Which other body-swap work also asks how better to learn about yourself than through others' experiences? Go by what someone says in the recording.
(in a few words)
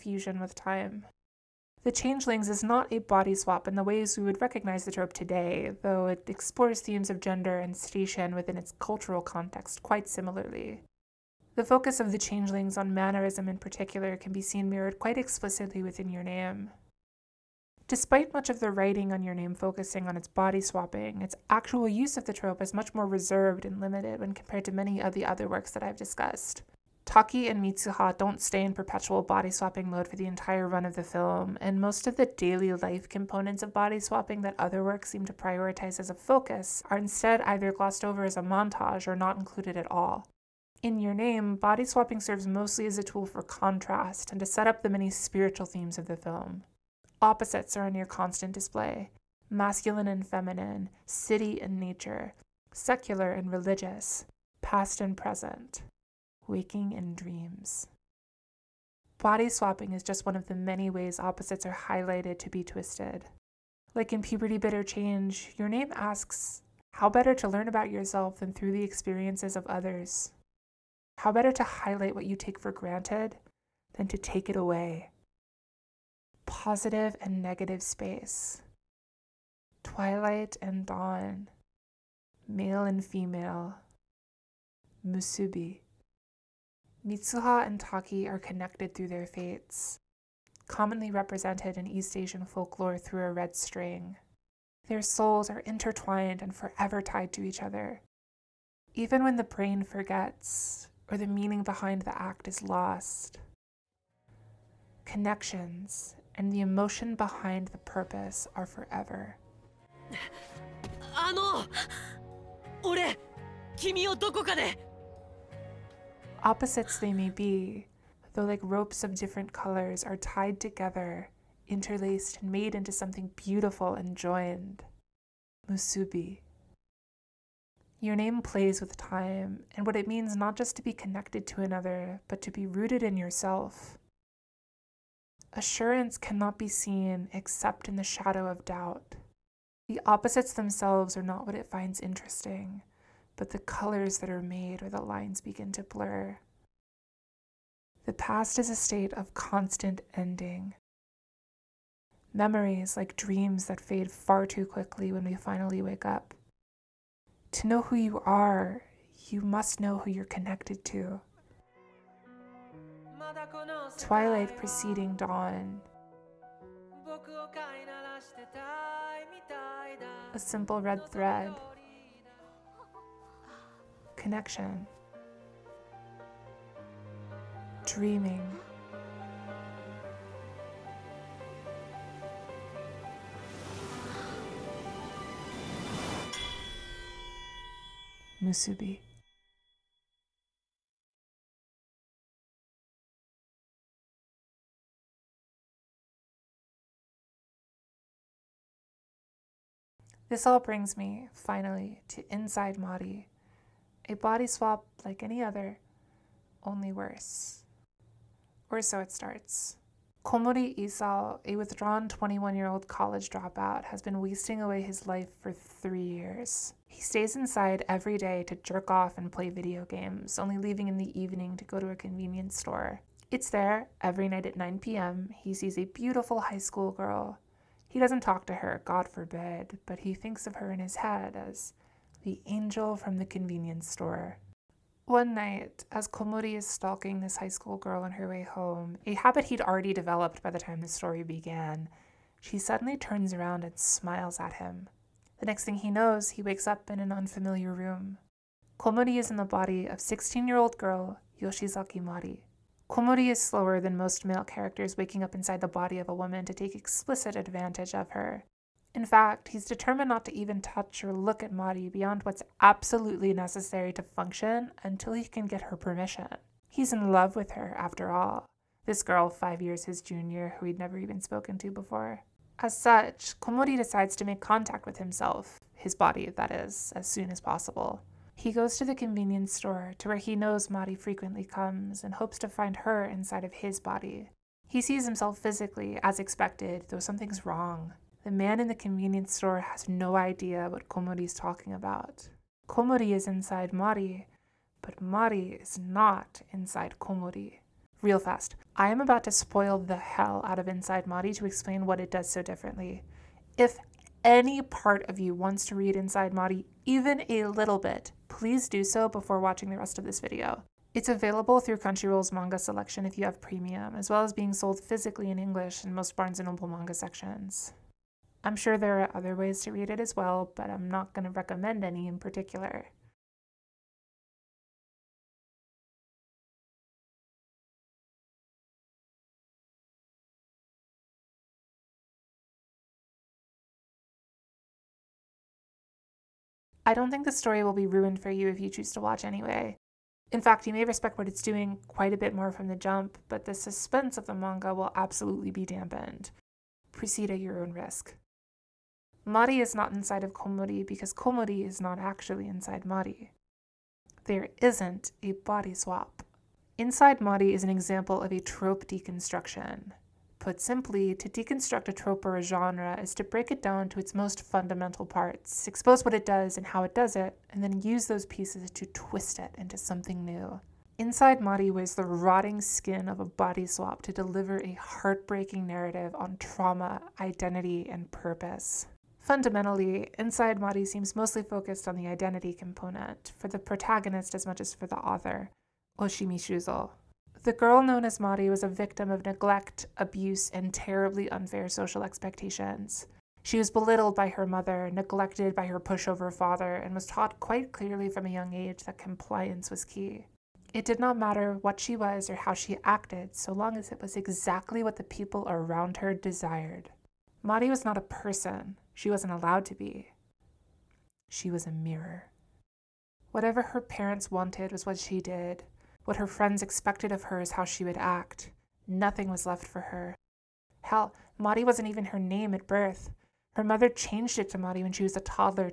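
Puberty Bitter Change.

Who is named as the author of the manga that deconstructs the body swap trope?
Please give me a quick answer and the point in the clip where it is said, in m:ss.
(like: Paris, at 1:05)
Oshimi Shuzo, at 6:25.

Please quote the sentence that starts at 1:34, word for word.
Their souls are intertwined and forever tied to each other.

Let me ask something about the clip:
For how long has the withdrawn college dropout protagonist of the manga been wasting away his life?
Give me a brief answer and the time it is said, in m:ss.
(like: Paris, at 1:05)
3 years, at 3:35.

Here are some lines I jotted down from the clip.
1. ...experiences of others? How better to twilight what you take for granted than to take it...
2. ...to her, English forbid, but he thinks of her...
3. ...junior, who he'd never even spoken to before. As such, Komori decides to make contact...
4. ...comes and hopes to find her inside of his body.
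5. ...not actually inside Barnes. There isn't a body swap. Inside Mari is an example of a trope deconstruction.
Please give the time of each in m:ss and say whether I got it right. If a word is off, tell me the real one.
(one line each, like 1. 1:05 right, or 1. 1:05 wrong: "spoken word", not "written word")
1. 1:08 wrong: "highlight", not "twilight"
2. 3:48 wrong: "God", not "English"
3. 4:30 right
4. 4:41 right
5. 5:51 wrong: "Mari", not "Barnes".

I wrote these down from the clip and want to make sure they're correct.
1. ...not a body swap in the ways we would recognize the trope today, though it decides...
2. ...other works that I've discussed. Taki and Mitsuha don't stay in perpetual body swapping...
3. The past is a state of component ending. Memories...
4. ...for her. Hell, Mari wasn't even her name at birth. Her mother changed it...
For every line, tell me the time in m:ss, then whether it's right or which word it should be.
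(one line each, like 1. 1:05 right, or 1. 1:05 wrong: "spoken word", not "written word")
1. 0:02 wrong: "explores", not "decides"
2. 0:25 right
3. 2:28 wrong: "constant", not "component"
4. 6:59 right.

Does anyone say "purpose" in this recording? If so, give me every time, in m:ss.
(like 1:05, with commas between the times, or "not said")
1:47, 6:18.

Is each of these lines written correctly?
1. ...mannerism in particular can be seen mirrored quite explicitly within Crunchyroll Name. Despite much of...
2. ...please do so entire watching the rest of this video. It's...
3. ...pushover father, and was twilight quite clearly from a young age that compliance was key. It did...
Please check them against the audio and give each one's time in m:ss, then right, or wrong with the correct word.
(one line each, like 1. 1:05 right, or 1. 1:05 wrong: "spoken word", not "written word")
1. 0:12 wrong: "Your", not "Crunchyroll"
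2. 5:08 wrong: "before", not "entire"
3. 6:35 wrong: "taught", not "twilight".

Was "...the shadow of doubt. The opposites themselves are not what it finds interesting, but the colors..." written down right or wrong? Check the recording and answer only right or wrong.
right.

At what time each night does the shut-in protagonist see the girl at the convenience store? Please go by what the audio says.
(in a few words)
9 p.m.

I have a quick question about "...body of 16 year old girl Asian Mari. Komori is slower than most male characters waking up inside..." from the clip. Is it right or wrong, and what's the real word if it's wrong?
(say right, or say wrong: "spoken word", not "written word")
wrong: "Yoshizaki", not "Asian".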